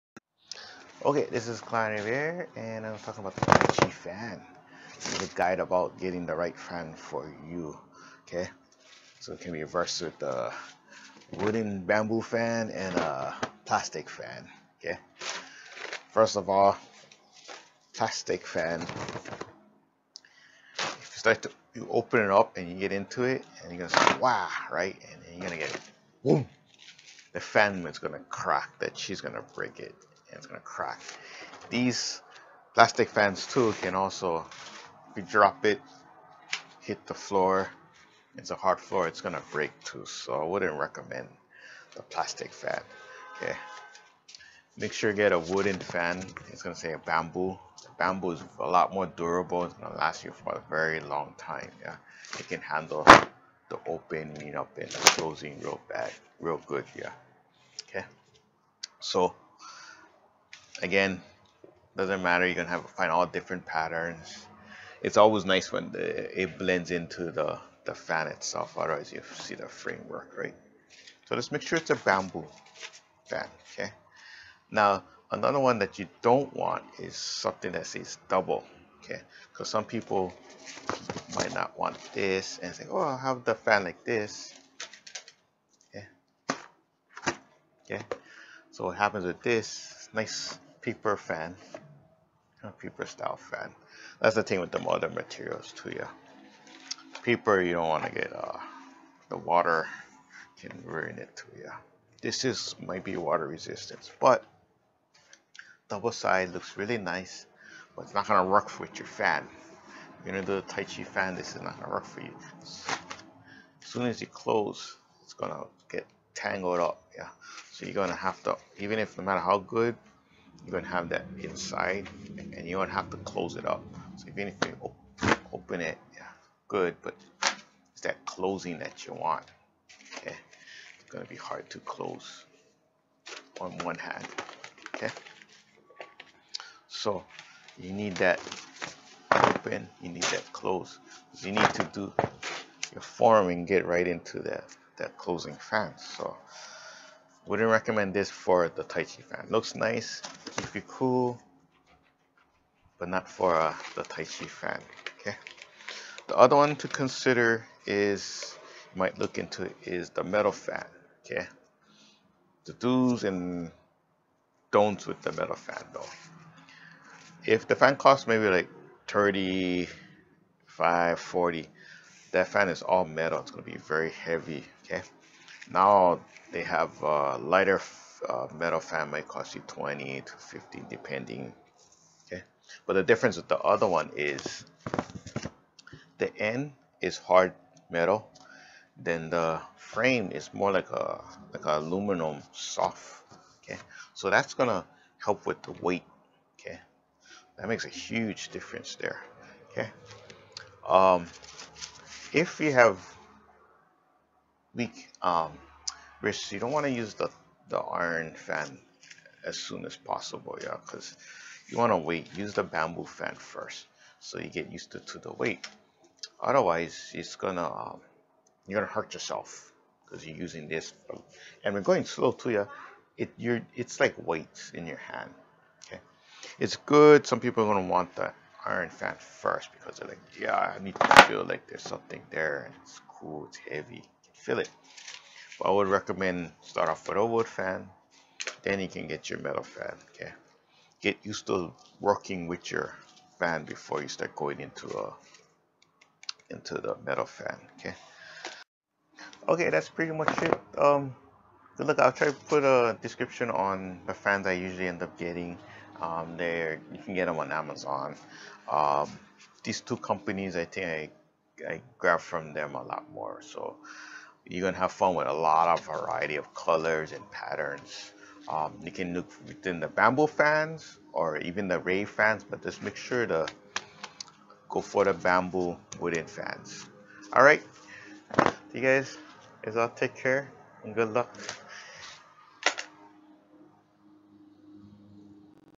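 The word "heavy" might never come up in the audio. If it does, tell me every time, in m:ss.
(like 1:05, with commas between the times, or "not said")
2:54, 3:53.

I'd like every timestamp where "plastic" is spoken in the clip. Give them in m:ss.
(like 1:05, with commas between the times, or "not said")
0:13, 0:17, 0:32, 0:42.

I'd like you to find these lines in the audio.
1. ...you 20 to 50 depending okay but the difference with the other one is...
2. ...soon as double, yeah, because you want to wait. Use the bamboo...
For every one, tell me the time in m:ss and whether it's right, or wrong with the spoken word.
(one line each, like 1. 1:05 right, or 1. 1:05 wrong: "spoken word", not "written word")
1. 2:59 right
2. 3:29 wrong: "possible", not "double".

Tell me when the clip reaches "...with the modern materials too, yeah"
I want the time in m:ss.
1:34.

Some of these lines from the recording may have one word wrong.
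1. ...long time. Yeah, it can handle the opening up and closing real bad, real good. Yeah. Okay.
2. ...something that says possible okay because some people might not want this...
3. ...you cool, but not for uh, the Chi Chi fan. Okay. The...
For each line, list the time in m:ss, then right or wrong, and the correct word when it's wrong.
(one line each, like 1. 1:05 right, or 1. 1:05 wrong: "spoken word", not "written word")
1. 0:51 right
2. 1:17 wrong: "double", not "possible"
3. 2:30 wrong: "Tai", not "Chi".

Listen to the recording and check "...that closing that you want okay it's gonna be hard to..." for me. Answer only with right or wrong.
right.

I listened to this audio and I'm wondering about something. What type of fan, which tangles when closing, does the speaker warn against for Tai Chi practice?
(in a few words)
double side.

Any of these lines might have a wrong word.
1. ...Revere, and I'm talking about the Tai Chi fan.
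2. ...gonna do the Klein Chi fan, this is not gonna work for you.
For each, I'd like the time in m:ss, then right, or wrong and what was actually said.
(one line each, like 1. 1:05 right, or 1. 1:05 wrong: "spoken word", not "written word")
1. 0:01 right
2. 1:50 wrong: "Tai", not "Klein".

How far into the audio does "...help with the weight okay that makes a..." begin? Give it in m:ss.
3:15.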